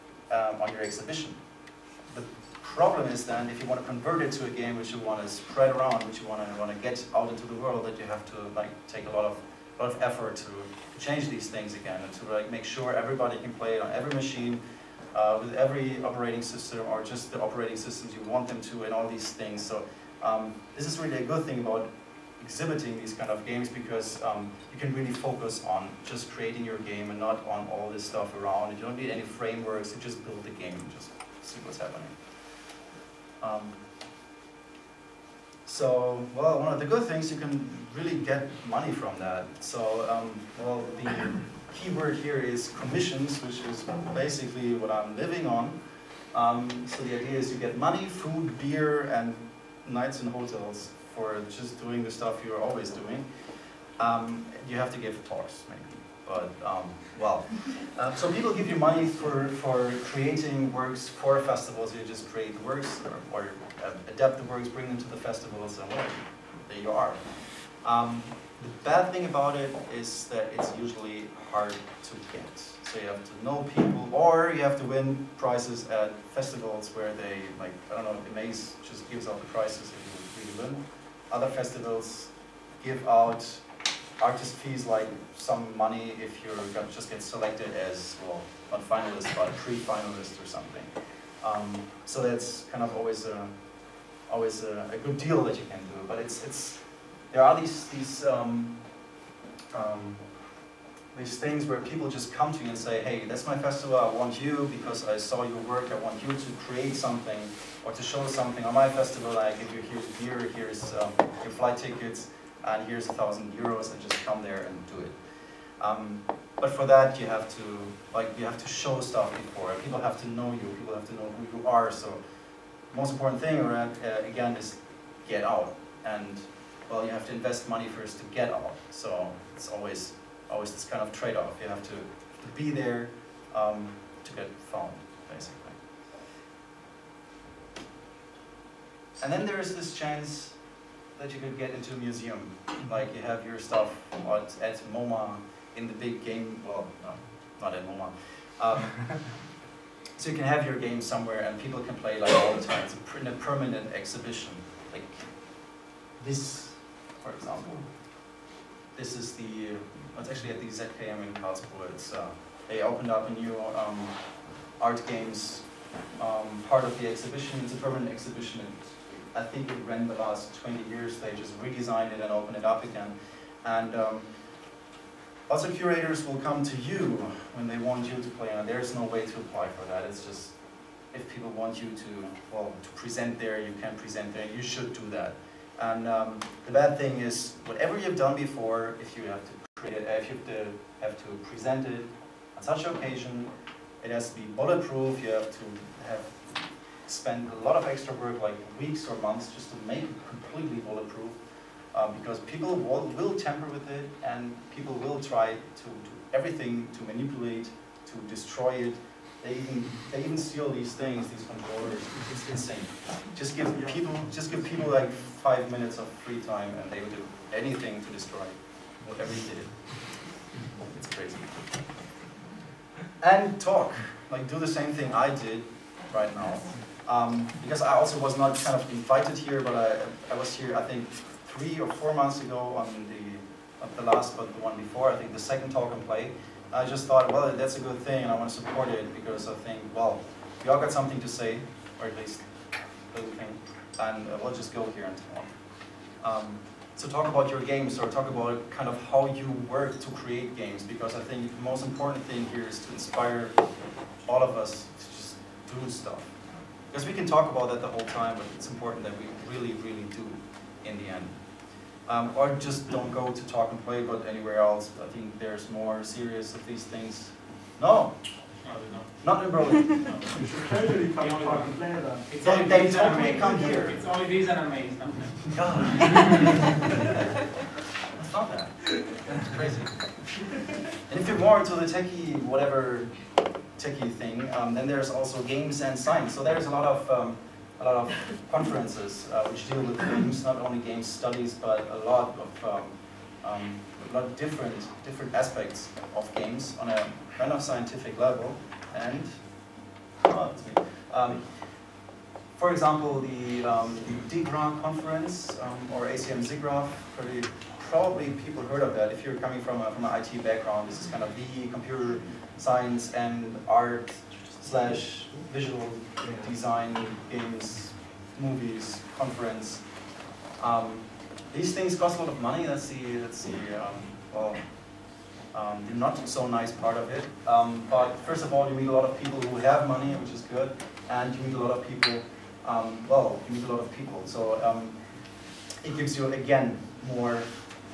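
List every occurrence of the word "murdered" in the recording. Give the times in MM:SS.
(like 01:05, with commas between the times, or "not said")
not said.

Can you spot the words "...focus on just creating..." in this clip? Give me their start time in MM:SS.
00:25.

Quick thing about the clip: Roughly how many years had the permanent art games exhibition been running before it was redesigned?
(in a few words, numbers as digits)
20 years.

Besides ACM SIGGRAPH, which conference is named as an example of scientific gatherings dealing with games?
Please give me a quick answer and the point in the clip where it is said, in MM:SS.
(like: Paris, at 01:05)
DiGRA, at 05:04.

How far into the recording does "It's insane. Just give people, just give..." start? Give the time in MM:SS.
03:32.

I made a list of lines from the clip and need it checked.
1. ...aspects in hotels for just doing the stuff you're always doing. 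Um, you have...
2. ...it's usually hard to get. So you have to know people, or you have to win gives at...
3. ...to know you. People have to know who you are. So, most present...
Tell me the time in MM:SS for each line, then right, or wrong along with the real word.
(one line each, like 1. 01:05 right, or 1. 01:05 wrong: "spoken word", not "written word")
1. 00:49 wrong: "nights", not "aspects"
2. 01:10 wrong: "prizes", not "gives"
3. 02:00 wrong: "important", not "present".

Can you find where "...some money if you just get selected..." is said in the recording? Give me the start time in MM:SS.
01:25.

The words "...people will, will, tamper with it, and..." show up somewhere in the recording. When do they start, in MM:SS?
03:22.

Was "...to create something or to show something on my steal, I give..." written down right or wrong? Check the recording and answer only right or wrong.
wrong.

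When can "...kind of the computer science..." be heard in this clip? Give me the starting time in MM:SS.
05:11.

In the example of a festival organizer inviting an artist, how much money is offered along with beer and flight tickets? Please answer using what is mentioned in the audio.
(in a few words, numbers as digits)
1000 euros.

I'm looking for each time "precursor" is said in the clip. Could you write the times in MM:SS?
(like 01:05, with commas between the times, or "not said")
not said.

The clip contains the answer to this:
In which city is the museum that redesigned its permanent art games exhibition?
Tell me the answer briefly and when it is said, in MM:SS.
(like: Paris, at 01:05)
Karlsruhe, at 02:41.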